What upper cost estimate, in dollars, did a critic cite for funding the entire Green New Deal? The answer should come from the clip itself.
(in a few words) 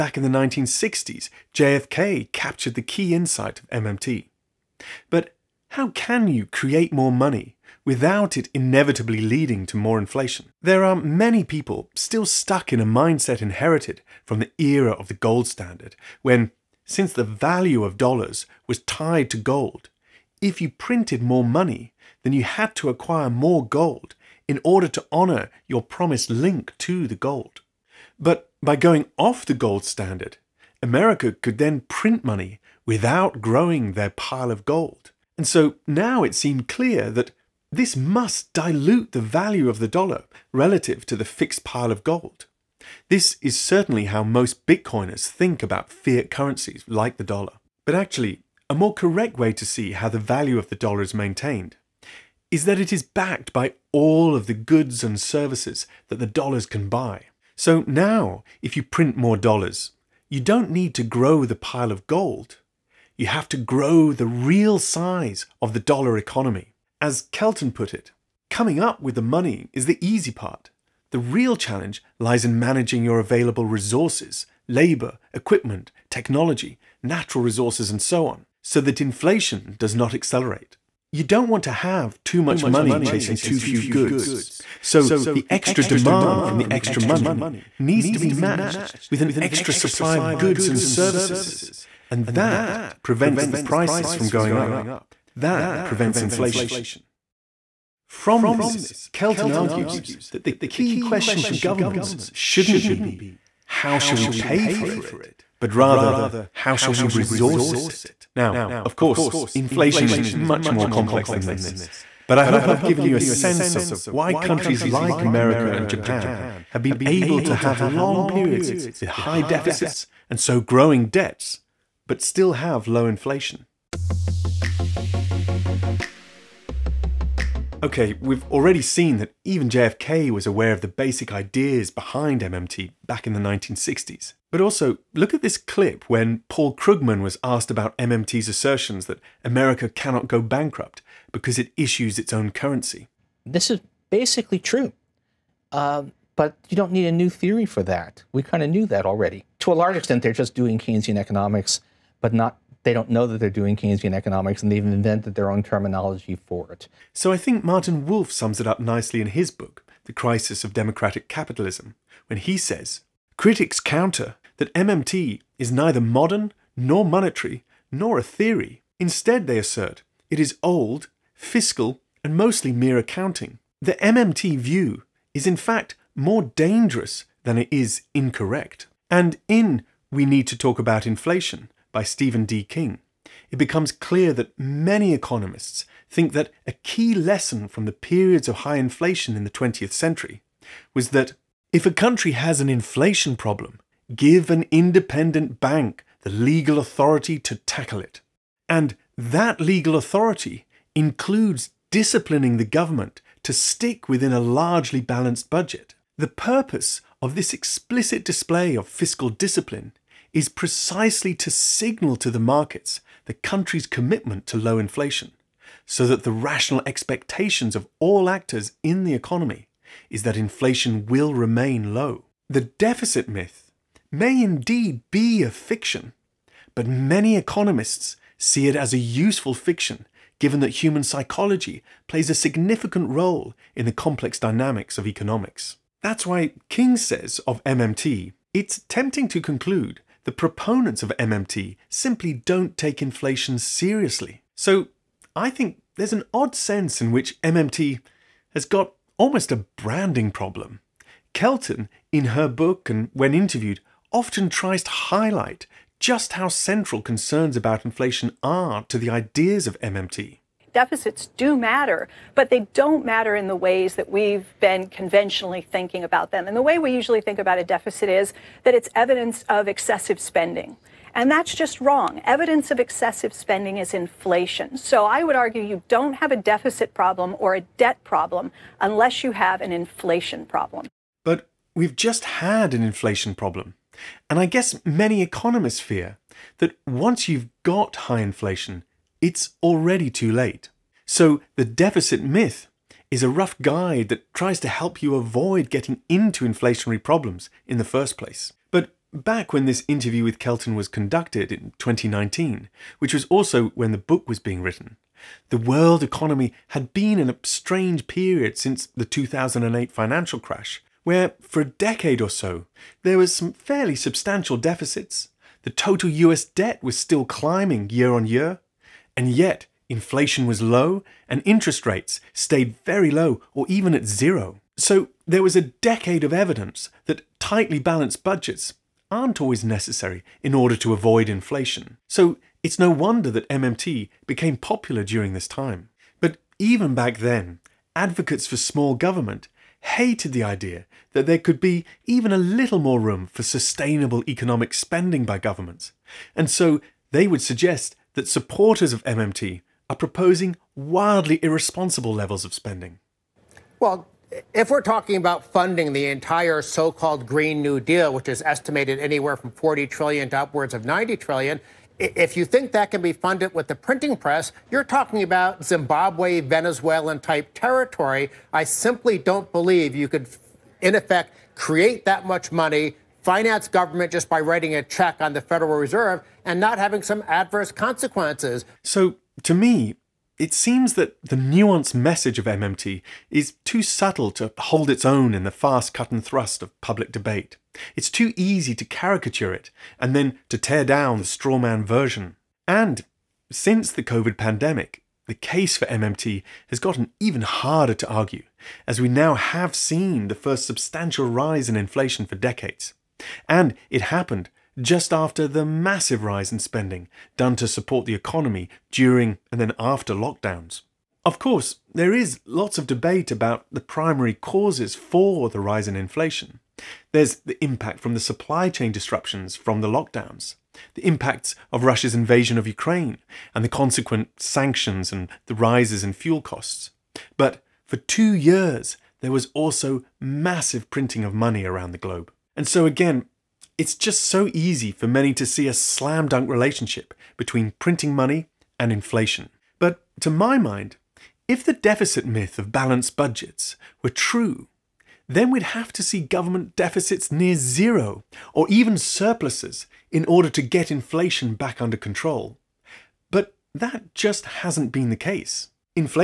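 90 trillion.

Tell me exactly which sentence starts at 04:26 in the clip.
And the way we usually think about a deficit is that it's evidence of excessive spending.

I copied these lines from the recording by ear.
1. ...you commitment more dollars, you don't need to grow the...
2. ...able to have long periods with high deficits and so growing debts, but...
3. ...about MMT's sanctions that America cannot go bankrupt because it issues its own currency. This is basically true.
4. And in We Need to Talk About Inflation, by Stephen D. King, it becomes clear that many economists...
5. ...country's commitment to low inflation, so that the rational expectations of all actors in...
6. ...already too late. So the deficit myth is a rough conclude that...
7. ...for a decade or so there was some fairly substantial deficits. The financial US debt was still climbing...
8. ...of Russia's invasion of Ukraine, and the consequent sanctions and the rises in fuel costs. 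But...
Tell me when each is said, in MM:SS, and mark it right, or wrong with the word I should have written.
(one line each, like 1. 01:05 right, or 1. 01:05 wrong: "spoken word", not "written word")
1. 00:58 wrong: "print", not "commitment"
2. 01:57 right
3. 02:17 wrong: "assertions", not "sanctions"
4. 02:59 right
5. 03:33 right
6. 04:49 wrong: "guide", not "conclude"
7. 05:11 wrong: "total", not "financial"
8. 07:01 right.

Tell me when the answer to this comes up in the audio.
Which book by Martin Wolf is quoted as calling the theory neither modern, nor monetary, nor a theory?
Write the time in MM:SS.
02:40.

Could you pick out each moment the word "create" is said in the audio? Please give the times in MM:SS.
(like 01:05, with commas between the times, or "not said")
00:06, 06:11.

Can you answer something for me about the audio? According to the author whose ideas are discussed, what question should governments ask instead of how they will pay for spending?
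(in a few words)
How shall we resource it?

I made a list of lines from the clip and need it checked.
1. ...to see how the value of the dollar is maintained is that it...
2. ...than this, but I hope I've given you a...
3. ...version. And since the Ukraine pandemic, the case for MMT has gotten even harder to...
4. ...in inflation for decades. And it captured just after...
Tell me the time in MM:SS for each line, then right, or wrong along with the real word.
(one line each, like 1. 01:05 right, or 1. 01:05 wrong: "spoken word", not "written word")
1. 00:49 right
2. 01:51 right
3. 06:31 wrong: "COVID", not "Ukraine"
4. 06:41 wrong: "happened", not "captured".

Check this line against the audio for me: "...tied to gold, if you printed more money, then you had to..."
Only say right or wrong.
right.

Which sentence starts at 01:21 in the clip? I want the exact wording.
You don't want to have too much money chasing too few goods.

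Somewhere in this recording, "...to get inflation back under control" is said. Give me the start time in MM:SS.
07:30.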